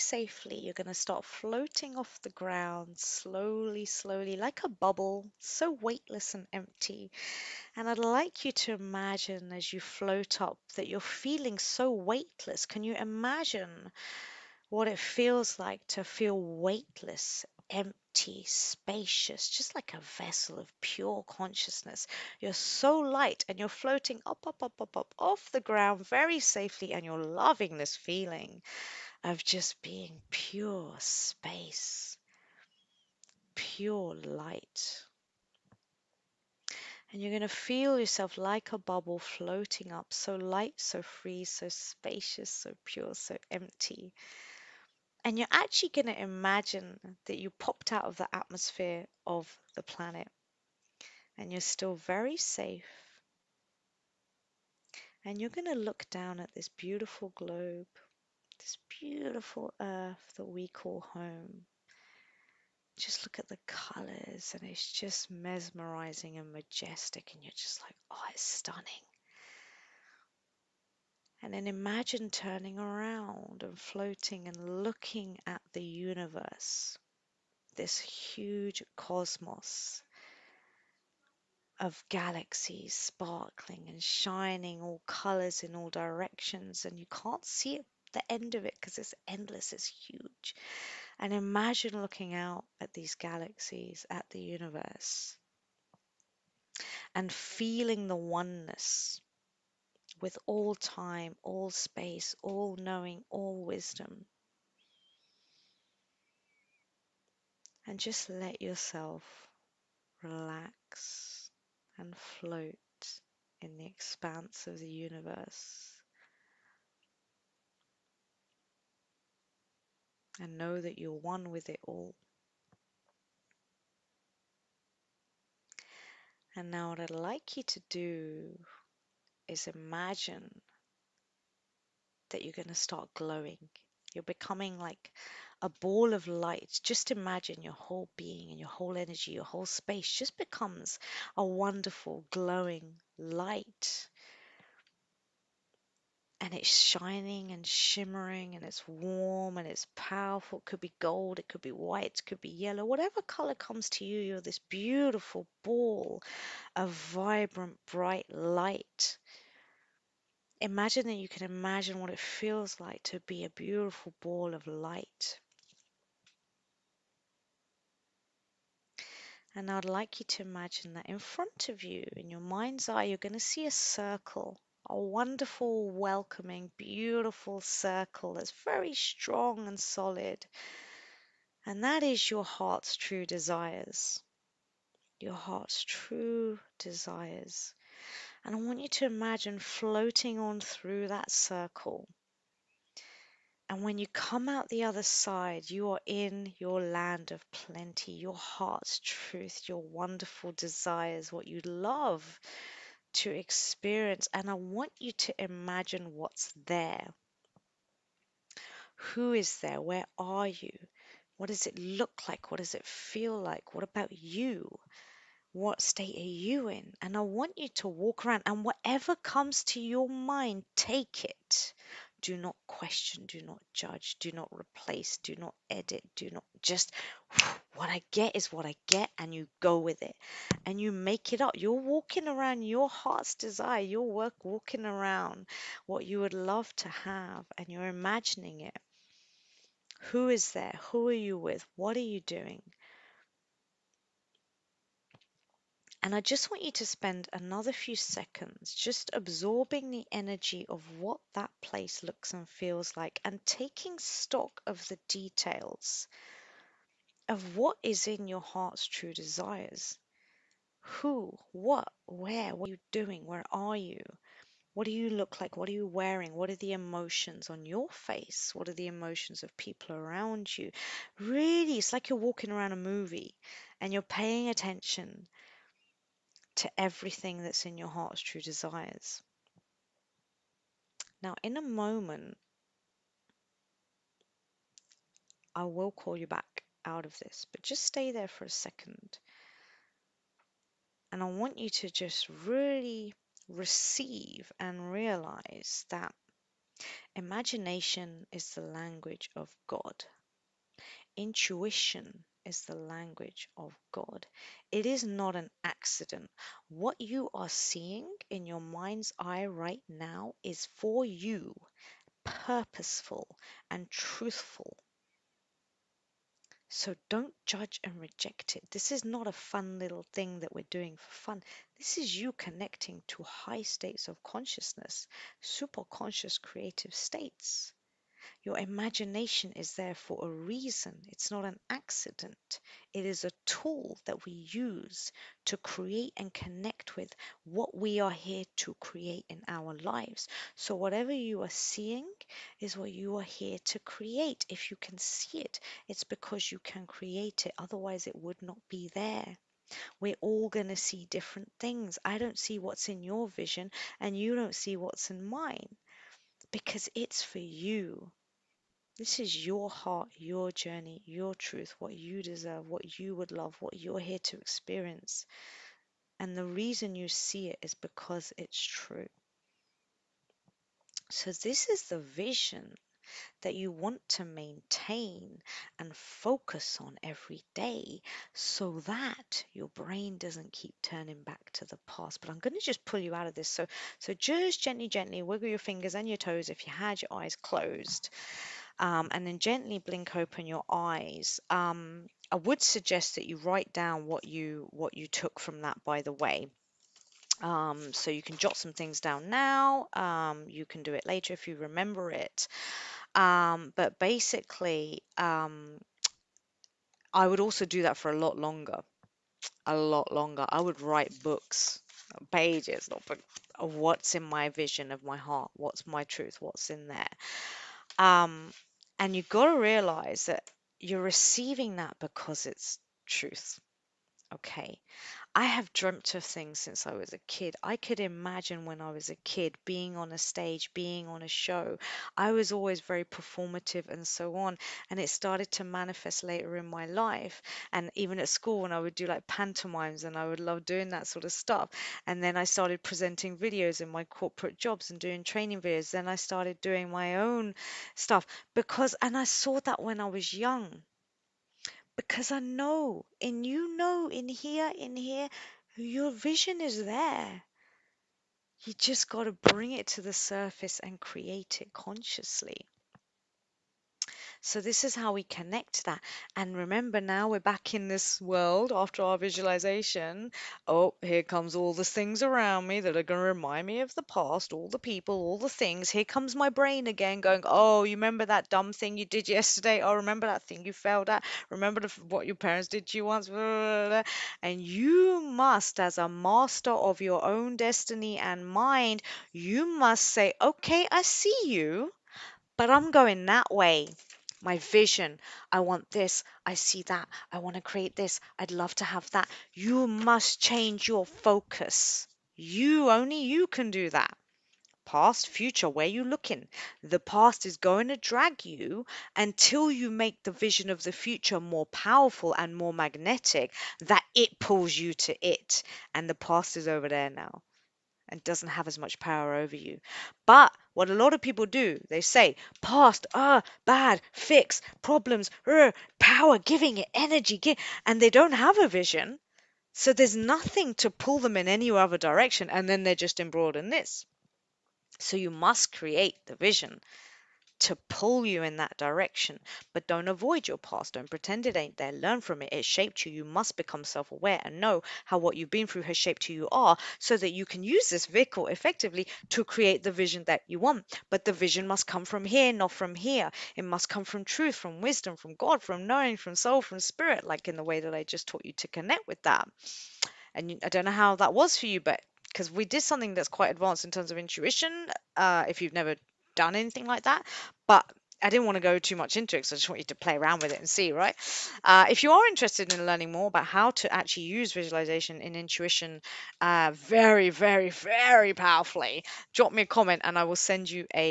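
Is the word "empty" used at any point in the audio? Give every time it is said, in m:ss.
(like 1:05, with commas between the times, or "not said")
0:06, 0:17, 0:43.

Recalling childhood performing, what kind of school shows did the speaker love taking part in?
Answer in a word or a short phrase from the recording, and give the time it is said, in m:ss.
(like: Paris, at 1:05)
pantomimes, at 7:19.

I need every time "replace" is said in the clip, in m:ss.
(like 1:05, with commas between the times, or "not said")
3:44.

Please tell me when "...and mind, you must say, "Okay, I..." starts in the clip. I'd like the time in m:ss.
8:08.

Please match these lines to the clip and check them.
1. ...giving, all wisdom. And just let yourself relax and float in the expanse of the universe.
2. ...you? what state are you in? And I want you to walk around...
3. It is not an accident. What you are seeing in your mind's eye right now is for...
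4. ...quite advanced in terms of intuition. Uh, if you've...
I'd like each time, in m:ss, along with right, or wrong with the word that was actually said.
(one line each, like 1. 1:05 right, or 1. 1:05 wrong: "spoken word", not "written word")
1. 1:42 wrong: "knowing", not "giving"
2. 3:34 right
3. 5:04 right
4. 9:23 right.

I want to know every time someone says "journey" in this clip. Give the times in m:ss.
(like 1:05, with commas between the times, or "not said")
6:00.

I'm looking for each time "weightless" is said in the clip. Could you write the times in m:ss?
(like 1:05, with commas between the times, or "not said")
0:05, 0:11, 0:16.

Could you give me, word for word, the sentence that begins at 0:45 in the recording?
And you're actually going to imagine that you popped out of the atmosphere of the planet and you're still very safe.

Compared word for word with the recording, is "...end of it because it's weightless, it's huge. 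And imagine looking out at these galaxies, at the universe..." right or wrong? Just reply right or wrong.
wrong.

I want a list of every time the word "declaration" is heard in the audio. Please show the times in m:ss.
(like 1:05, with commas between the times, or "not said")
not said.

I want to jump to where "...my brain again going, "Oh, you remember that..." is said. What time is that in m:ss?
7:56.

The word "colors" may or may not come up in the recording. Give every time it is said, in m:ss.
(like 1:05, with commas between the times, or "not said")
1:03, 1:25, 2:33.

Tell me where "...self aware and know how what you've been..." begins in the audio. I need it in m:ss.
9:03.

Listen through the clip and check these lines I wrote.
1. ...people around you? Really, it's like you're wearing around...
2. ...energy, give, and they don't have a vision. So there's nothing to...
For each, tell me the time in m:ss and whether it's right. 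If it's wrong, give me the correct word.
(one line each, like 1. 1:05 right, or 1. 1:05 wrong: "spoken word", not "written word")
1. 4:29 wrong: "walking", not "wearing"
2. 8:46 right.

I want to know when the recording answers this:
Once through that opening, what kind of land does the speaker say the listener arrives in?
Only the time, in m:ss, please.
3:16.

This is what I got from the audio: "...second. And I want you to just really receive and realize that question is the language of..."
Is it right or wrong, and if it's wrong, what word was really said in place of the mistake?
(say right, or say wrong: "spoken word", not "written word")
wrong: "imagination", not "question".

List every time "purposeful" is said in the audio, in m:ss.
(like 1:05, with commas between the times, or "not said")
5:12.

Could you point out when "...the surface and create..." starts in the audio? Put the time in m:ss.
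7:40.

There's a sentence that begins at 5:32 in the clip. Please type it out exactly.
It is a tool that we use to create and connect with what we are here to create in our lives.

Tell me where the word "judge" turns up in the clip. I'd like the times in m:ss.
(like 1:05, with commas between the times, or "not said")
3:43, 5:17.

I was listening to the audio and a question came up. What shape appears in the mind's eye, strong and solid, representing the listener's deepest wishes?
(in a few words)
a circle.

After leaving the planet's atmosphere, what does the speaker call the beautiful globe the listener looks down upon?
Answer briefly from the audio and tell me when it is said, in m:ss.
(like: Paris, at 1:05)
home, at 1:01.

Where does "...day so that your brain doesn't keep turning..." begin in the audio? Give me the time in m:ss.
6:17.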